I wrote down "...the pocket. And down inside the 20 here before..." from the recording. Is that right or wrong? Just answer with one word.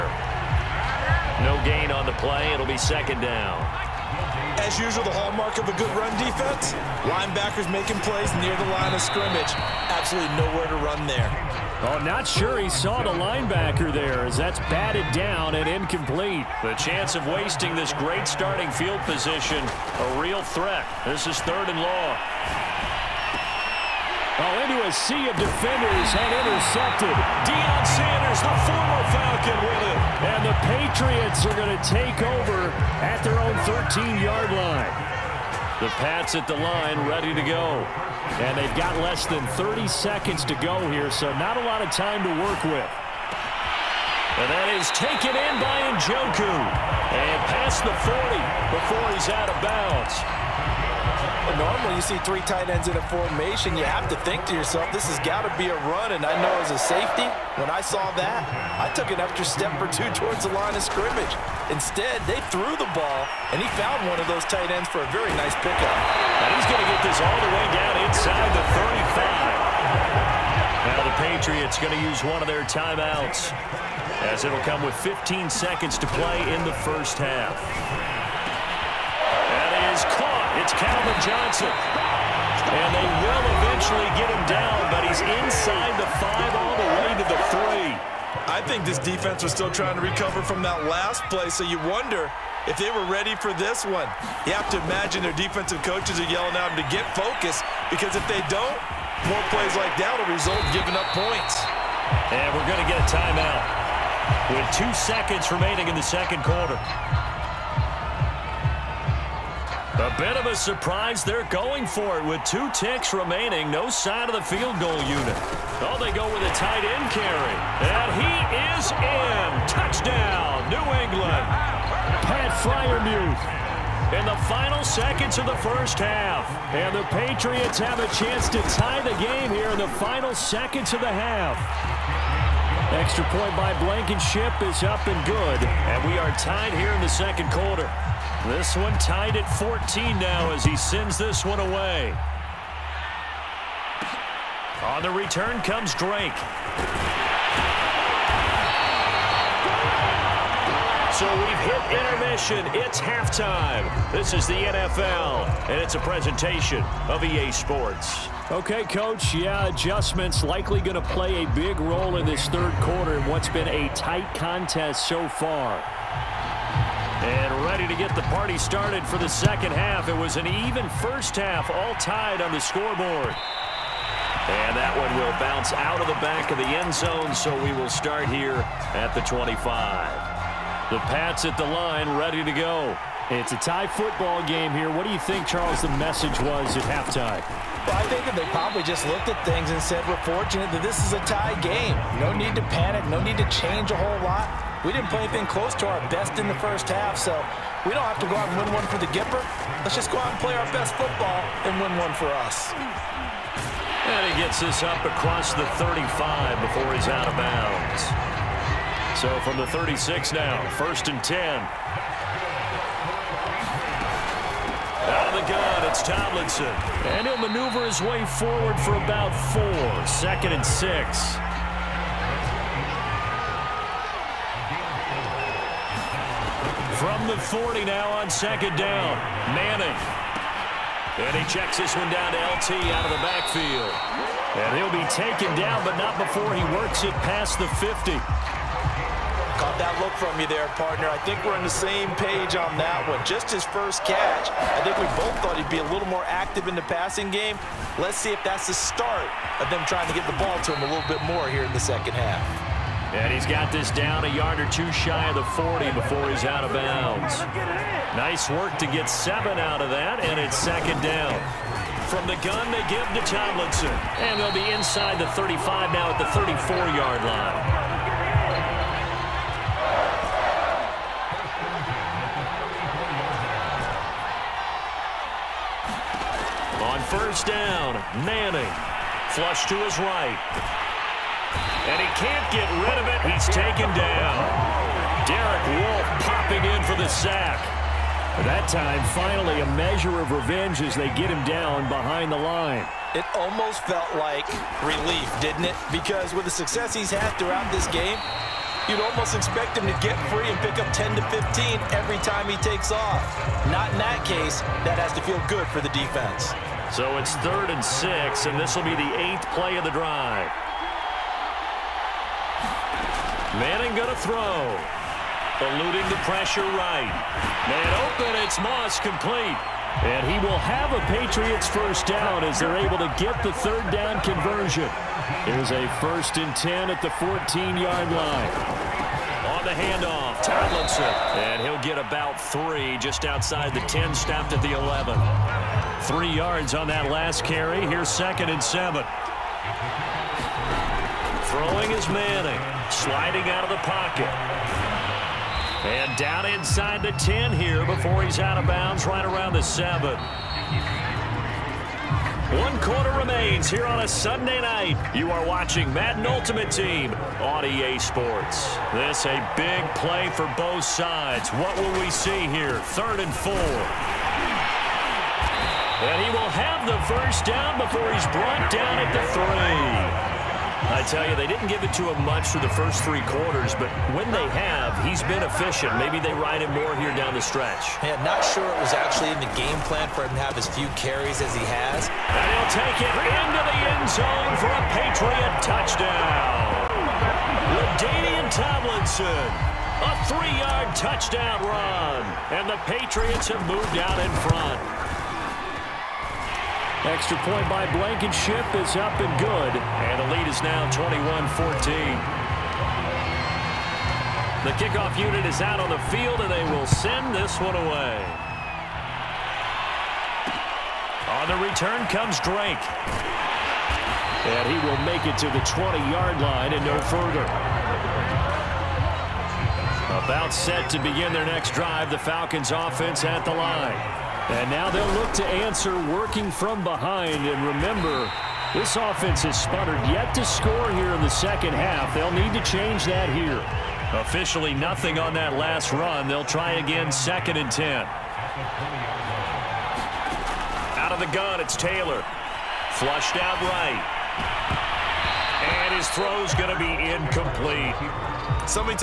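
wrong.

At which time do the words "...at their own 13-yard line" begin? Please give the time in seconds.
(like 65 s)
33 s.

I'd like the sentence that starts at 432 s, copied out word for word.
They'll need to change that here.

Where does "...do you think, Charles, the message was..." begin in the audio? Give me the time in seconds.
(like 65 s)
185 s.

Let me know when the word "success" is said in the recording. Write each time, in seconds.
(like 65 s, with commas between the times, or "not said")
296 s.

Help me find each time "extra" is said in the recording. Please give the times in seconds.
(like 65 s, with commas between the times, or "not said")
59 s, 132 s, 397 s.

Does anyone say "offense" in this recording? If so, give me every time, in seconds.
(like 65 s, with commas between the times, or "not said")
422 s, 428 s.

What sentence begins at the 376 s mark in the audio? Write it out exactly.
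Maybe they ride him more here down the stretch.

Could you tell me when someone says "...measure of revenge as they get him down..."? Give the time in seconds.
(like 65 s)
289 s.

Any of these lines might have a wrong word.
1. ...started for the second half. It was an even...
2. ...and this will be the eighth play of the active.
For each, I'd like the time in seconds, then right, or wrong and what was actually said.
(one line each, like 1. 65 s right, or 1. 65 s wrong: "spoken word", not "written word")
1. 168 s right
2. 308 s wrong: "drive", not "active".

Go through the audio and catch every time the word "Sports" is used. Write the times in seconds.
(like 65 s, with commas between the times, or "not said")
157 s, 357 s.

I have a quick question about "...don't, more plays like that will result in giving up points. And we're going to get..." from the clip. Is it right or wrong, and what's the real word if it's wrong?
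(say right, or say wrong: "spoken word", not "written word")
right.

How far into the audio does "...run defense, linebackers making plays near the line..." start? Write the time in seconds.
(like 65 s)
5 s.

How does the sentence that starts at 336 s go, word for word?
Three yards on that last carry.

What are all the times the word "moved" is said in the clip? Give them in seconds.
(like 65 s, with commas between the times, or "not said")
393 s.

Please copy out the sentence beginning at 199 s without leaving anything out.
Let's just go out and play our best football and win one for us.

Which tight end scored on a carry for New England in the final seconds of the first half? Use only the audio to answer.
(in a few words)
Pat Freiermuth.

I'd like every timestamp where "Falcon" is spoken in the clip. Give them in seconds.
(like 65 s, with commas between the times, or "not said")
29 s, 422 s.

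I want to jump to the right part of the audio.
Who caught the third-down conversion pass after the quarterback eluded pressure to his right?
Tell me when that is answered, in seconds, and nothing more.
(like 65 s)
318 s.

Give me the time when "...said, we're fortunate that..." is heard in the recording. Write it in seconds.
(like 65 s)
189 s.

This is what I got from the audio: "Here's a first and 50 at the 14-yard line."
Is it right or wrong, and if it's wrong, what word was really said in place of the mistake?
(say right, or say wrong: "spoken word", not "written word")
wrong: "10", not "50".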